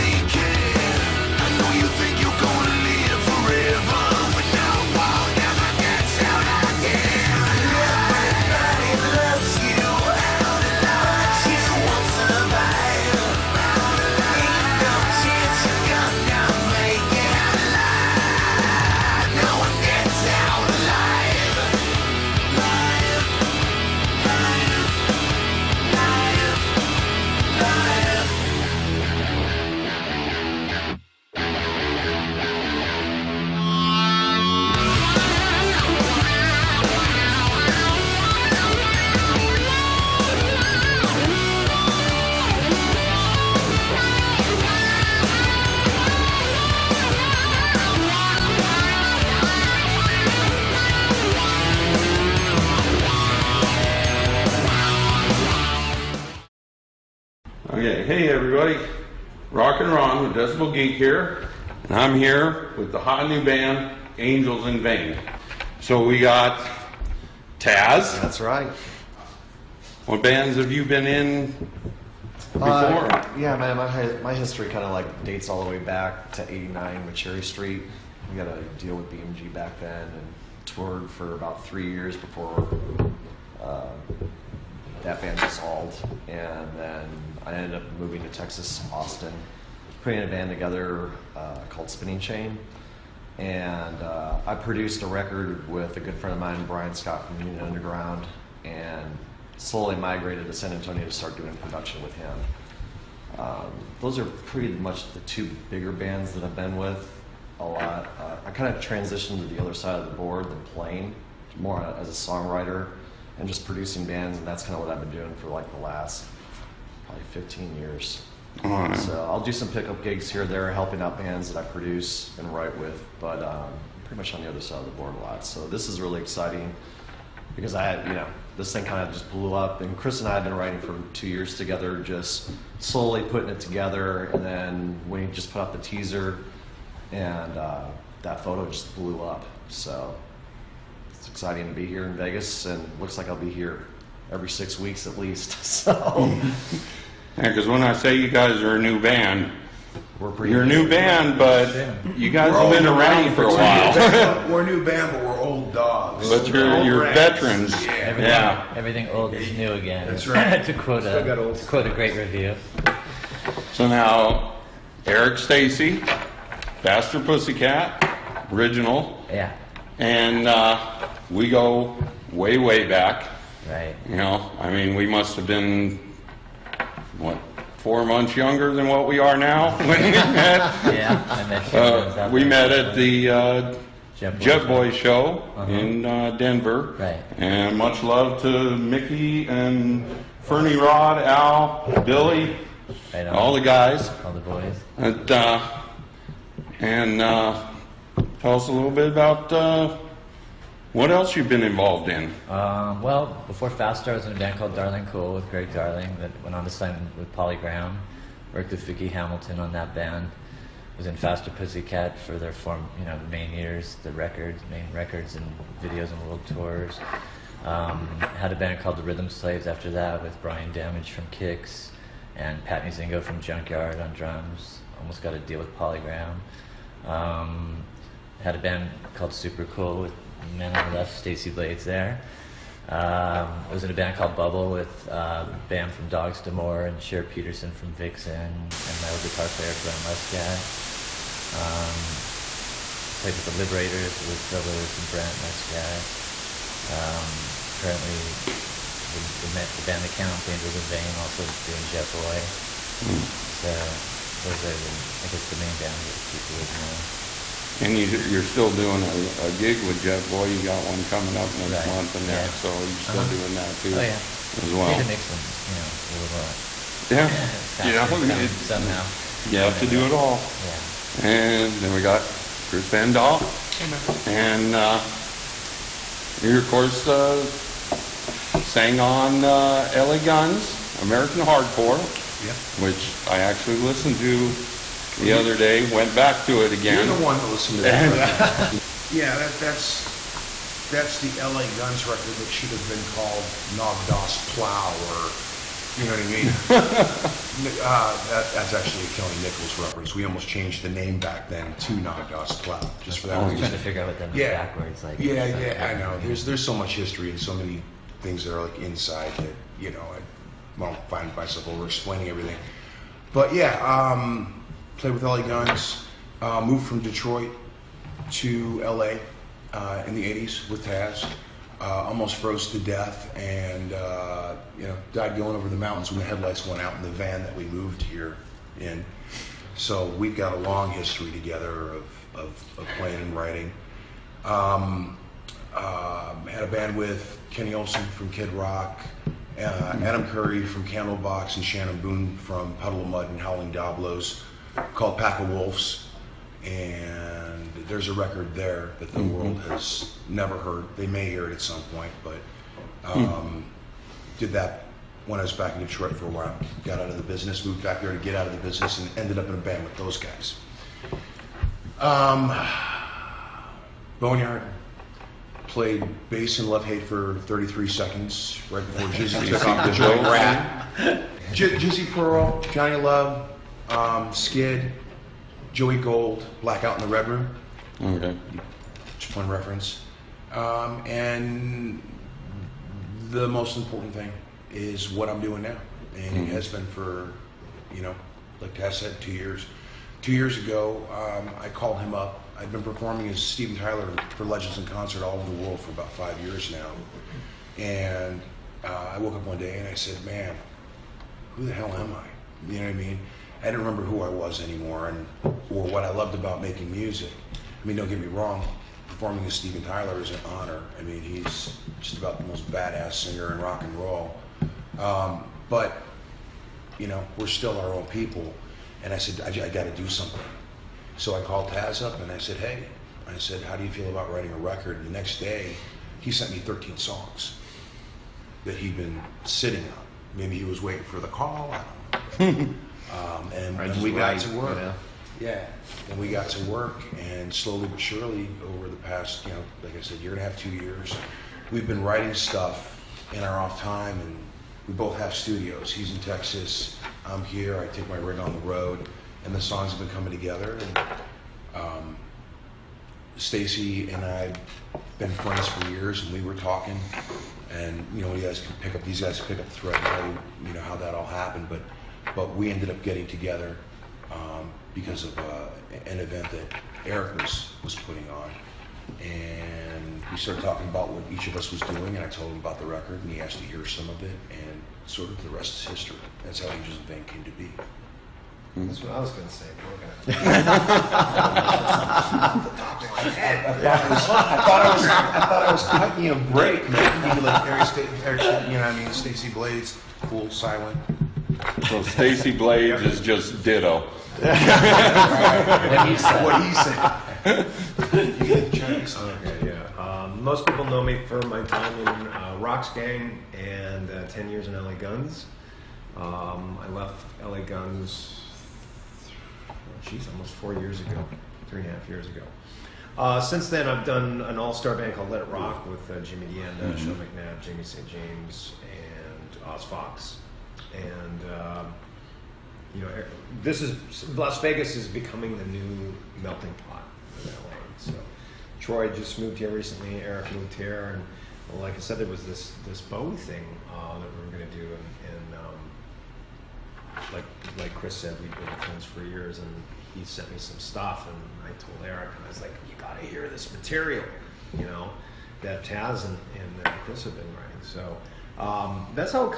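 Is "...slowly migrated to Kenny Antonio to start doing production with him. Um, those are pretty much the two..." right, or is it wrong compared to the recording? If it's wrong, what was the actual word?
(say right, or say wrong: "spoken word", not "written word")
wrong: "San", not "Kenny".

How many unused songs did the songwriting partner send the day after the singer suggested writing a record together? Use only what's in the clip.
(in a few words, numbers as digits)
13.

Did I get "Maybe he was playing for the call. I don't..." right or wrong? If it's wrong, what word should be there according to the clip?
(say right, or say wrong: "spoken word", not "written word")
wrong: "waiting", not "playing".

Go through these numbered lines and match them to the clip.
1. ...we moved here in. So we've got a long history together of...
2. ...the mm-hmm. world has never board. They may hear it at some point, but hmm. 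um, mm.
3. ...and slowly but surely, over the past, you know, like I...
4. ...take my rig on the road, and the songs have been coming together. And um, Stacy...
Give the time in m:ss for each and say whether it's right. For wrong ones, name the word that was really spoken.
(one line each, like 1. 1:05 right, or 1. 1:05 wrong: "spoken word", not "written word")
1. 5:27 right
2. 5:49 wrong: "heard", not "board"
3. 7:17 right
4. 7:27 right.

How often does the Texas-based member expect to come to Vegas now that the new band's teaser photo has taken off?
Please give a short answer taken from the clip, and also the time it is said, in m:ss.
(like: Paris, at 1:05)
Every six weeks, at 2:24.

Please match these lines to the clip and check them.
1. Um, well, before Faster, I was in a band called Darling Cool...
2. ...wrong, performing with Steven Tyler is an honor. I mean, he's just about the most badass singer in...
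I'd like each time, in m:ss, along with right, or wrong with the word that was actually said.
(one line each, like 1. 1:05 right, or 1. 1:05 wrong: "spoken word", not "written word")
1. 3:22 right
2. 6:48 right.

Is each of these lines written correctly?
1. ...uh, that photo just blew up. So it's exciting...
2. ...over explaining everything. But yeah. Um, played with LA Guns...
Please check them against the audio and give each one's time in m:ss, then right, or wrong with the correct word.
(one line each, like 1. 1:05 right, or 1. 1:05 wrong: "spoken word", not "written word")
1. 2:17 right
2. 5:11 right.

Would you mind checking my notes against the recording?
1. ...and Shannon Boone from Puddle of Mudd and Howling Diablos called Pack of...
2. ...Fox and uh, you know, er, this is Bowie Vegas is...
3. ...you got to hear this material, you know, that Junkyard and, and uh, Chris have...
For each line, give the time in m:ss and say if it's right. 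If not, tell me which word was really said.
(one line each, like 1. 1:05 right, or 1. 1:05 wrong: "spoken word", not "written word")
1. 5:41 right
2. 8:39 wrong: "Las", not "Bowie"
3. 9:02 wrong: "Taz", not "Junkyard".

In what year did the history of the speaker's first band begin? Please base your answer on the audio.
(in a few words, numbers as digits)
1989.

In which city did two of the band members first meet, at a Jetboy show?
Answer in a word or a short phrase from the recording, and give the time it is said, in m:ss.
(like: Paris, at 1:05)
Denver, at 3:06.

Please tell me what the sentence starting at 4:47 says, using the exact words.
You're the one that listened to that.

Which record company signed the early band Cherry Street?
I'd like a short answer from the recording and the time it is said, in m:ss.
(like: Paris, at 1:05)
BMG, at 1:19.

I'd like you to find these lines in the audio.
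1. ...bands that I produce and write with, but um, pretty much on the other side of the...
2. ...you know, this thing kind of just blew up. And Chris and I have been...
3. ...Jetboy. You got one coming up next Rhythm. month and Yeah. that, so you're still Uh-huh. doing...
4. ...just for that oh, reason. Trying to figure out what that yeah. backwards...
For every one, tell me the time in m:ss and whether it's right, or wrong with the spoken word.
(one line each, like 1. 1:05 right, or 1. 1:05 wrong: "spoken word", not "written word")
1. 2:01 right
2. 2:08 right
3. 4:20 wrong: "Right", not "Rhythm"
4. 5:03 right.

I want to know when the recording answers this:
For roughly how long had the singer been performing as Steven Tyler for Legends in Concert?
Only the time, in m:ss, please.
6:36.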